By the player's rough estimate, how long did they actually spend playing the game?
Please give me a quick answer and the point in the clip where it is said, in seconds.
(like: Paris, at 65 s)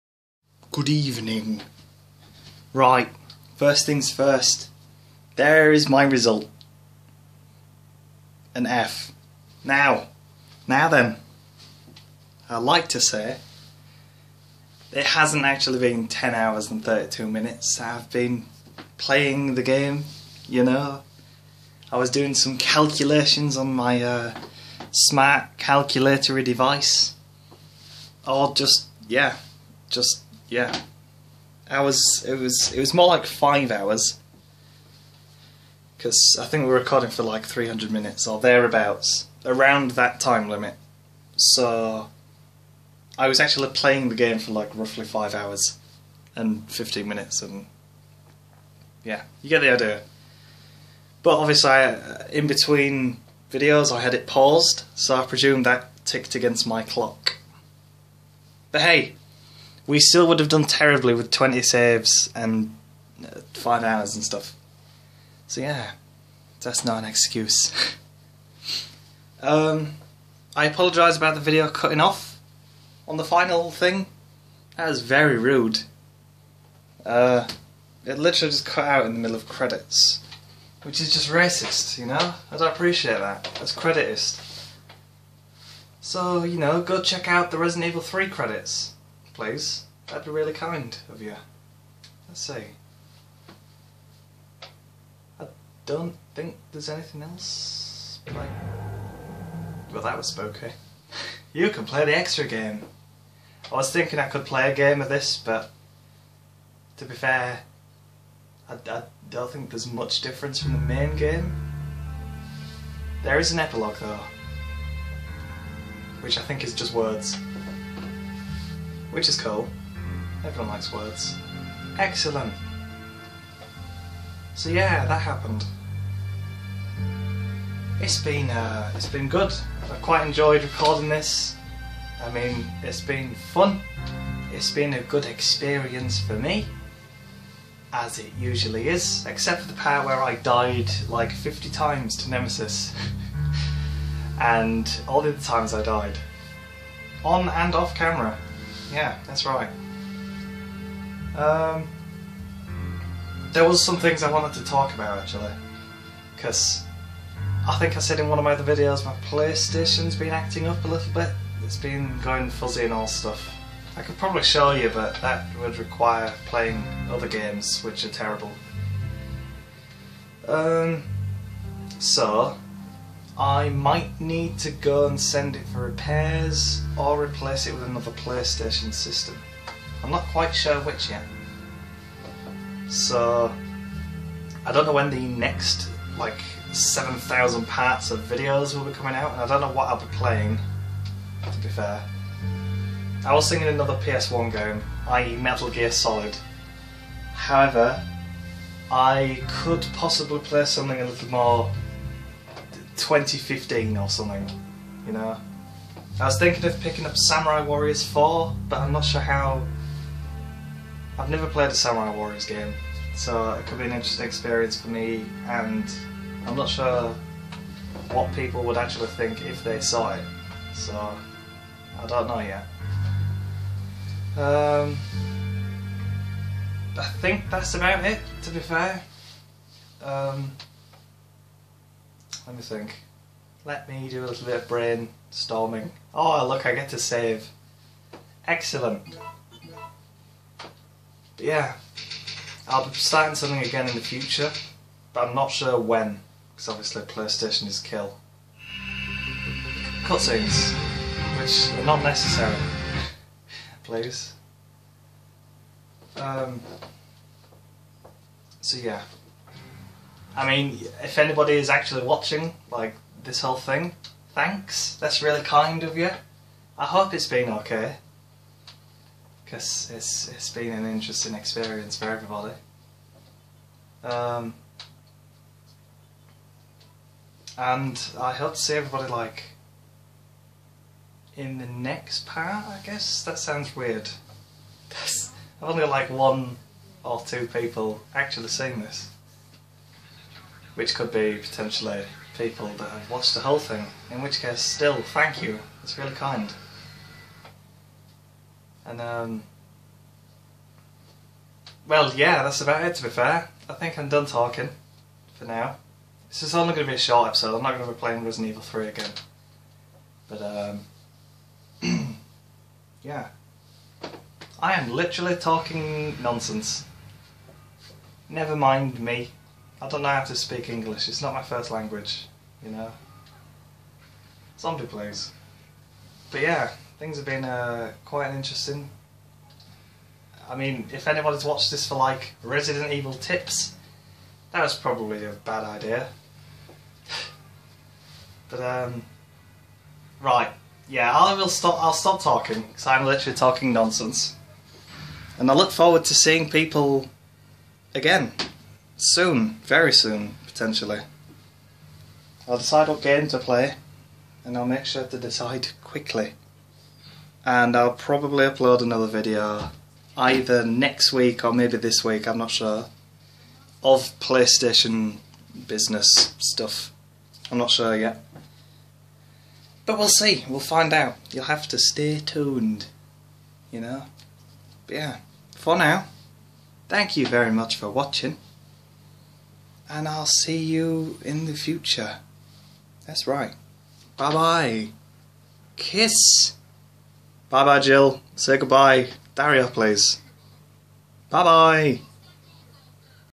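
5 hours and 15 minutes, at 45 s.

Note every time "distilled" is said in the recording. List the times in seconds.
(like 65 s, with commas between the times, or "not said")
not said.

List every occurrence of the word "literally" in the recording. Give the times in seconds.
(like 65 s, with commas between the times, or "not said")
78 s, 314 s, 343 s.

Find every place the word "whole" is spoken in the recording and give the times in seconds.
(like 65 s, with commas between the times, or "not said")
263 s, 293 s.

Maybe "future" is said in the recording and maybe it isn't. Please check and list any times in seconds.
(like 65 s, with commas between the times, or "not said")
244 s, 381 s.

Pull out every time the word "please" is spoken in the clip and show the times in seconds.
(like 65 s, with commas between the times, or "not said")
89 s, 253 s, 324 s, 389 s.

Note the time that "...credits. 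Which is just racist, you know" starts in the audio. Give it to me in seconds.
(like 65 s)
79 s.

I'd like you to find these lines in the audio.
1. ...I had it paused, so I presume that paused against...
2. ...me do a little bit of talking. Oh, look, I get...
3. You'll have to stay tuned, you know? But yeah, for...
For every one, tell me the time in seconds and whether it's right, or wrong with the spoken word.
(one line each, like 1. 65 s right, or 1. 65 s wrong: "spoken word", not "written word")
1. 53 s wrong: "ticked", not "paused"
2. 233 s wrong: "brainstorming", not "talking"
3. 371 s right.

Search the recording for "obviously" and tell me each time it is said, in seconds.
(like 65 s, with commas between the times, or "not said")
51 s, 246 s.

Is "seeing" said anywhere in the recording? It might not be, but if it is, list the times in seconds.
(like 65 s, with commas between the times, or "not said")
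288 s, 346 s.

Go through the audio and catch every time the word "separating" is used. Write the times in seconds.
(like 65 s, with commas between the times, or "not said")
not said.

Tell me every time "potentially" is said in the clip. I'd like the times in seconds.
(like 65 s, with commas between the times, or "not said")
291 s, 350 s.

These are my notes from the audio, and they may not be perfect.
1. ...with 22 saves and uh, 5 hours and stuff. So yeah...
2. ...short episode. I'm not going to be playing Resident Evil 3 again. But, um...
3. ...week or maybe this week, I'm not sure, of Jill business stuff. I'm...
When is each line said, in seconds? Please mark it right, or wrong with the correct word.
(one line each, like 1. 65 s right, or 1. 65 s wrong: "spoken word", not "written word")
1. 61 s wrong: "20", not "22"
2. 306 s right
3. 361 s wrong: "PlayStation", not "Jill".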